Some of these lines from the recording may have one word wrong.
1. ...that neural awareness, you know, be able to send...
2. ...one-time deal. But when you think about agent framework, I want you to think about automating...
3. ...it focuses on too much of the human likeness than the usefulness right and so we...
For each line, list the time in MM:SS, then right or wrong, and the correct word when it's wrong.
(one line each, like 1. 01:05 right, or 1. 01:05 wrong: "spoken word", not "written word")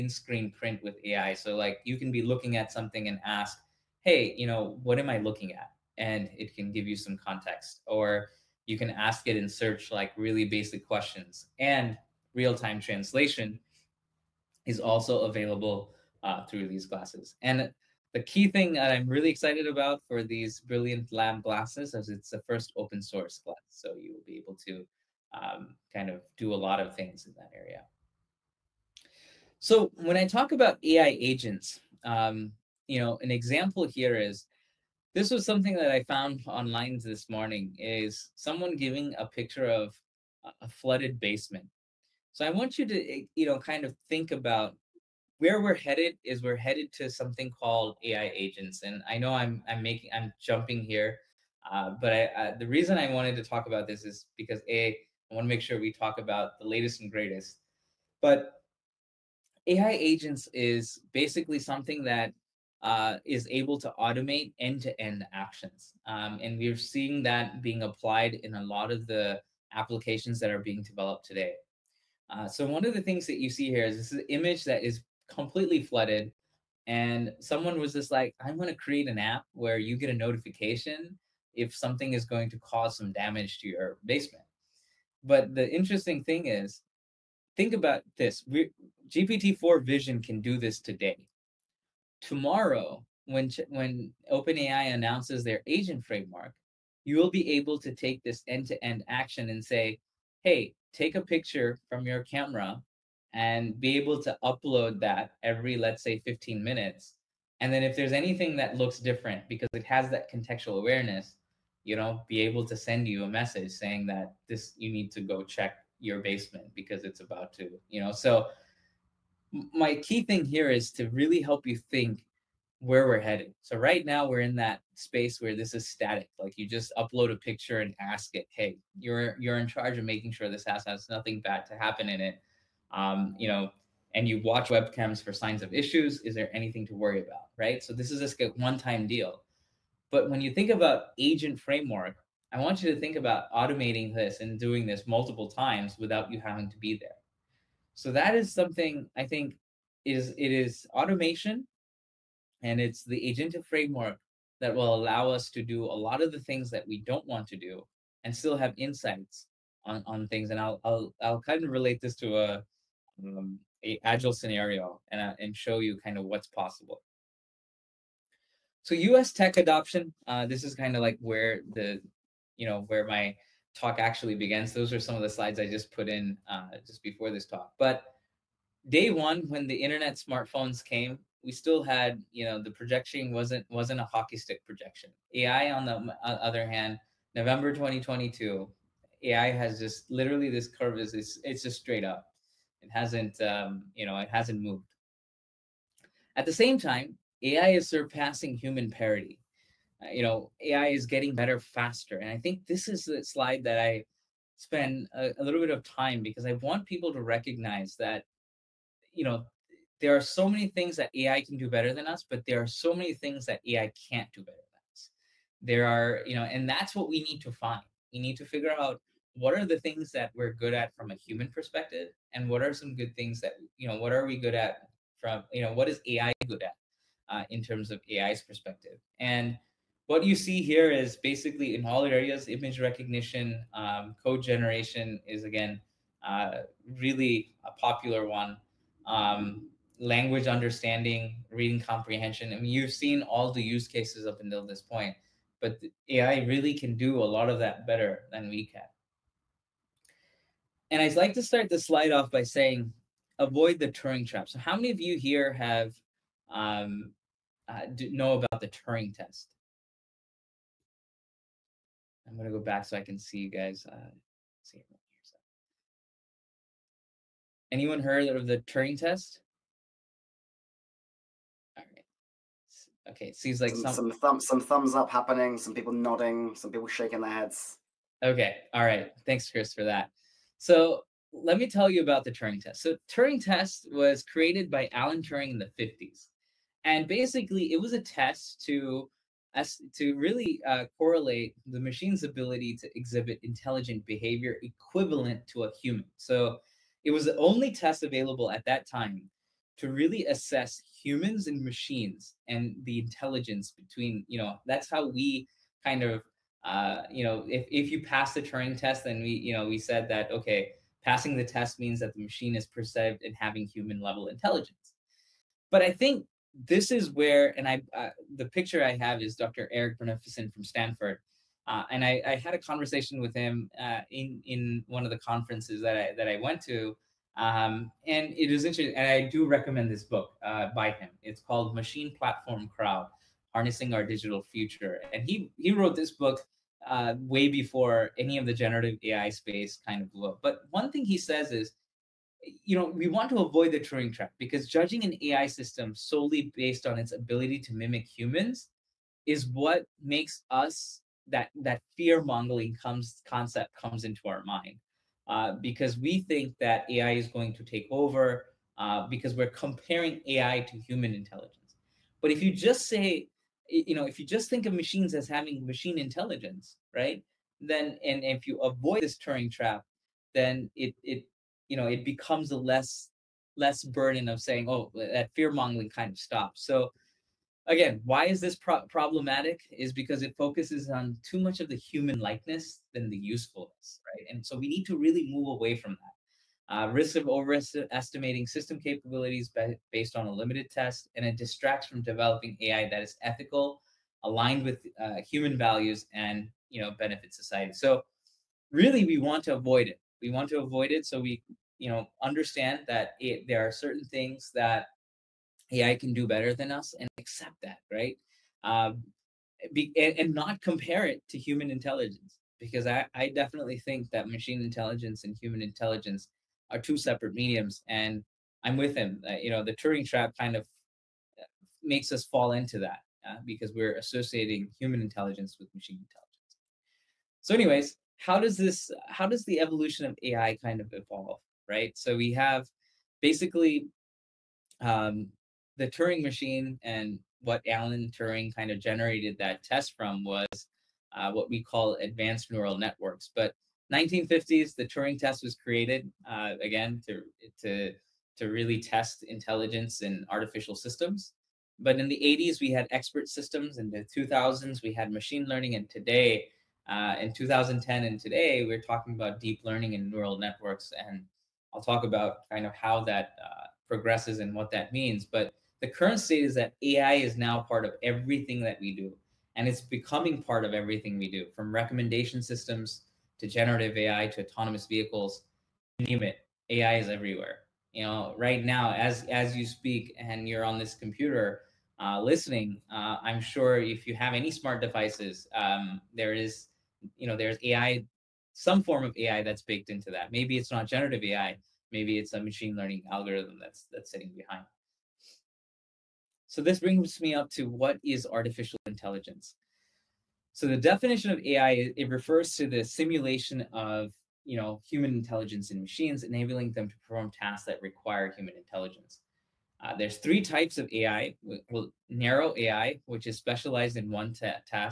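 1. 01:50 wrong: "contextual", not "neural"
2. 02:18 right
3. 06:20 right.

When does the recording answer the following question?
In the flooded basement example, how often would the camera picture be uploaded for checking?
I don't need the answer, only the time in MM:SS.
01:45.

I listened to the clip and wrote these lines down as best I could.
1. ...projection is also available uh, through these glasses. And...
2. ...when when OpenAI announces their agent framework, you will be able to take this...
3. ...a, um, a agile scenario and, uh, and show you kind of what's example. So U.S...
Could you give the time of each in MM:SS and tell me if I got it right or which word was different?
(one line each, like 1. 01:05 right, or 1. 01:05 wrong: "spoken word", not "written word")
1. 00:12 wrong: "translation", not "projection"
2. 01:33 right
3. 02:42 wrong: "possible", not "example".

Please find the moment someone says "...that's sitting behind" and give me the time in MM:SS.
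08:13.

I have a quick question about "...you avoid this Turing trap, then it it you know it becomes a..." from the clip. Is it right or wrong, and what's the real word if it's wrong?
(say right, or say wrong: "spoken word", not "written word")
right.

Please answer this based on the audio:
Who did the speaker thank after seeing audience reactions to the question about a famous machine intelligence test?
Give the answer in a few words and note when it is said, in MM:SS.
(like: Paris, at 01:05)
Chris, at 04:39.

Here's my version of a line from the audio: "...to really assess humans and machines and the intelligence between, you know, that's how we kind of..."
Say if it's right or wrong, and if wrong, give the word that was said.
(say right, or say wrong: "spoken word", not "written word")
right.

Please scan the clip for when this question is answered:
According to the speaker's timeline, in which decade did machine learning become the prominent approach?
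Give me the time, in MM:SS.
07:34.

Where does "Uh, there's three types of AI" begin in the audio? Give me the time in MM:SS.
08:29.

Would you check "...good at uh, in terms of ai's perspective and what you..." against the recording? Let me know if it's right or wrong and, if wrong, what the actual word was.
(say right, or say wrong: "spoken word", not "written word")
right.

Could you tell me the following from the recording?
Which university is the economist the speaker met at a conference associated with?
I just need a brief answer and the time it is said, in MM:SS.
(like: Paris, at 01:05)
Stanford, at 05:20.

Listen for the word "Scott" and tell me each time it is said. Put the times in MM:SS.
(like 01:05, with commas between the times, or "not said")
not said.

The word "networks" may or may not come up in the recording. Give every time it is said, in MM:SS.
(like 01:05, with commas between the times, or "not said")
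07:22, 07:40.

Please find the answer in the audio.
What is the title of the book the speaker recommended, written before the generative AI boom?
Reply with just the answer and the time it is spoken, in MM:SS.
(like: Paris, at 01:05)
Machine Platform Crowd, at 05:31.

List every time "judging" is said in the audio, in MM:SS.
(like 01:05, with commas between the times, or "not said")
05:44.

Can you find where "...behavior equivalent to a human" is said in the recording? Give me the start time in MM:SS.
04:54.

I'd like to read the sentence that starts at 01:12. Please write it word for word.
Uh, so one of the things that you see here is this is image that is completely flooded.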